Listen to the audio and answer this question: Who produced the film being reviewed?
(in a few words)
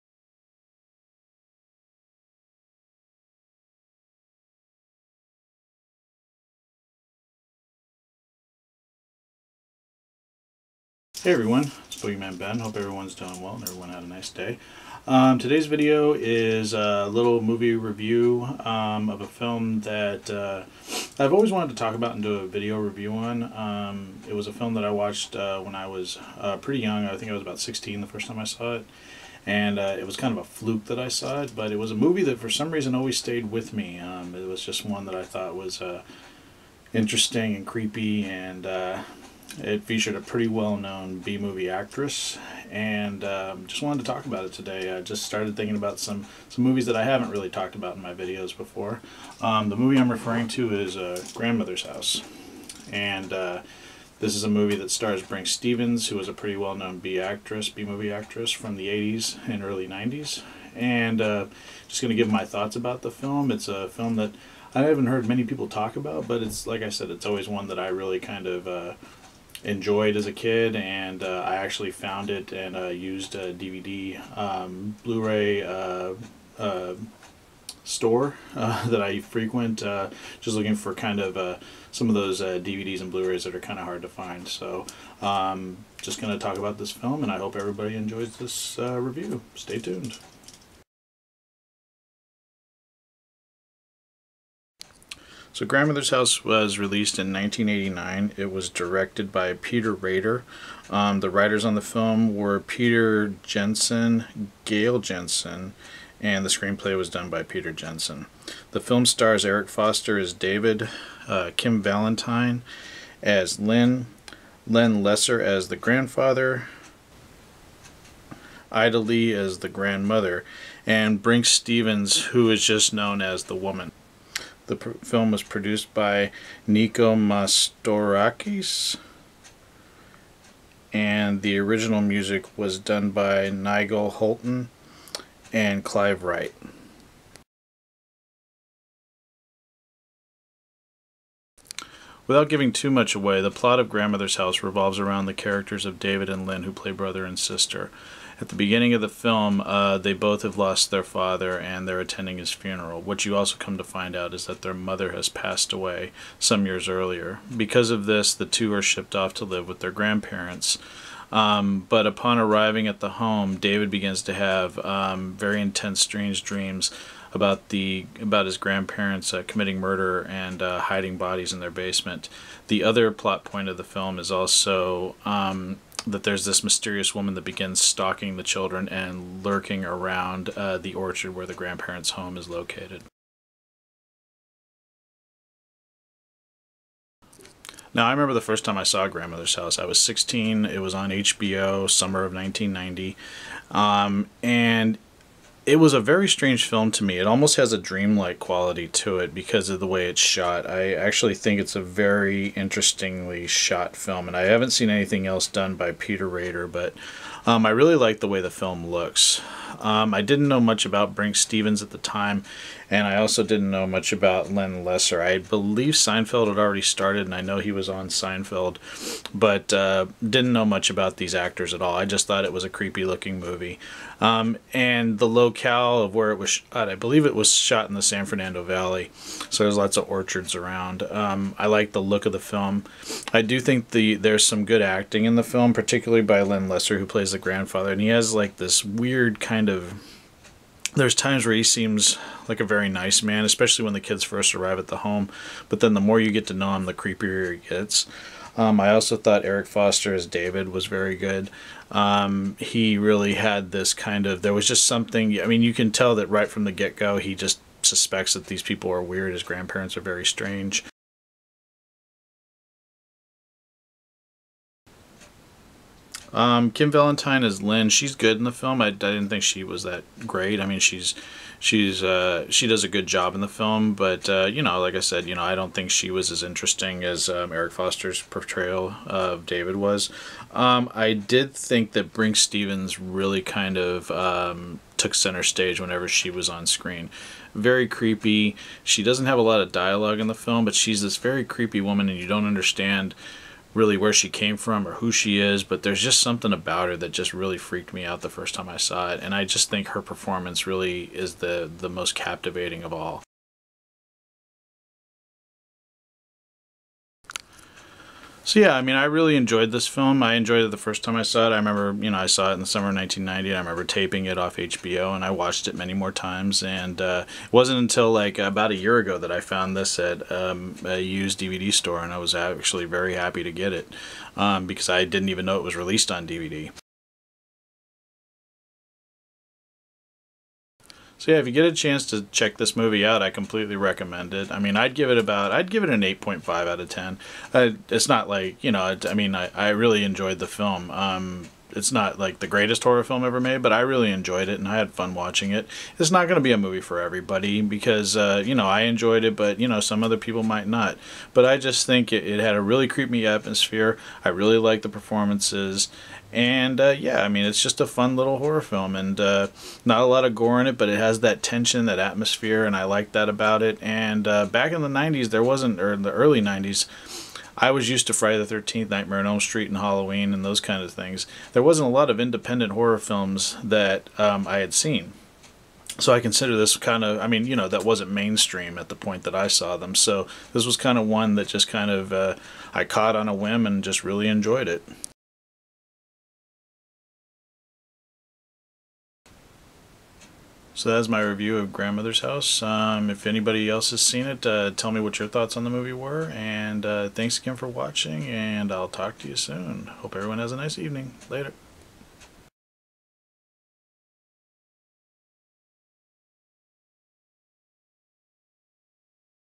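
Nico Mastorakis.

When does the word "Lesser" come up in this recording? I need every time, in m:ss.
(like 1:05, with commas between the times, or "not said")
1:55, 3:34, 3:56.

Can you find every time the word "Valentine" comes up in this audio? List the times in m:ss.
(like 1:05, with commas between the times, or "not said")
1:51, 4:26.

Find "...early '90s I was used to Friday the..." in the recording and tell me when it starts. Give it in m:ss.
6:06.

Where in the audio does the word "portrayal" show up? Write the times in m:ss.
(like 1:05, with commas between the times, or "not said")
4:38.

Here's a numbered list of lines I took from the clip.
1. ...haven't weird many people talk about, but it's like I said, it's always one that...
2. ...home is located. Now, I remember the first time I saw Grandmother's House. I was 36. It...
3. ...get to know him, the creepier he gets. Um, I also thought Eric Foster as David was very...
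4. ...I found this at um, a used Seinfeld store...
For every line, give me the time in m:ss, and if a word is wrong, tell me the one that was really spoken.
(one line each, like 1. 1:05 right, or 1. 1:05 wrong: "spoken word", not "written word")
1. 1:04 wrong: "heard", not "weird"
2. 3:02 wrong: "16", not "36"
3. 4:06 right
4. 5:19 wrong: "DVD", not "Seinfeld".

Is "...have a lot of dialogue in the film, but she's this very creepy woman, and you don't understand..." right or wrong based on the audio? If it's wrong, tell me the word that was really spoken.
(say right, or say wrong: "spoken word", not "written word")
right.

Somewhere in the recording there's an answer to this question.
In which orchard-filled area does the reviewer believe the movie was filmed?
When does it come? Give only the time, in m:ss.
3:48.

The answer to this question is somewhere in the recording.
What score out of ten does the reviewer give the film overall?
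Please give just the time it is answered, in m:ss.
5:36.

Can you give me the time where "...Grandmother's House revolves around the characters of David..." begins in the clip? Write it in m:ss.
2:23.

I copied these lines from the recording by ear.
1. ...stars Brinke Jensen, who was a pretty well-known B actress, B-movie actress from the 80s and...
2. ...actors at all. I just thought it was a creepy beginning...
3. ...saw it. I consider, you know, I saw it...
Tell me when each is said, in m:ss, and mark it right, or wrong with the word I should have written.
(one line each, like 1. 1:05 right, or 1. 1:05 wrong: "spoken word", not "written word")
1. 0:54 wrong: "Stevens", not "Jensen"
2. 3:41 wrong: "looking", not "beginning"
3. 5:11 wrong: "remember", not "consider".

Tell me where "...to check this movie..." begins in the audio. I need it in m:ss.
5:32.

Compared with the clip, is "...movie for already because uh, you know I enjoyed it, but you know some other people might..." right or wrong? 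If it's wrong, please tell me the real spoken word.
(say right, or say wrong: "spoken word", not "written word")
wrong: "everybody", not "already".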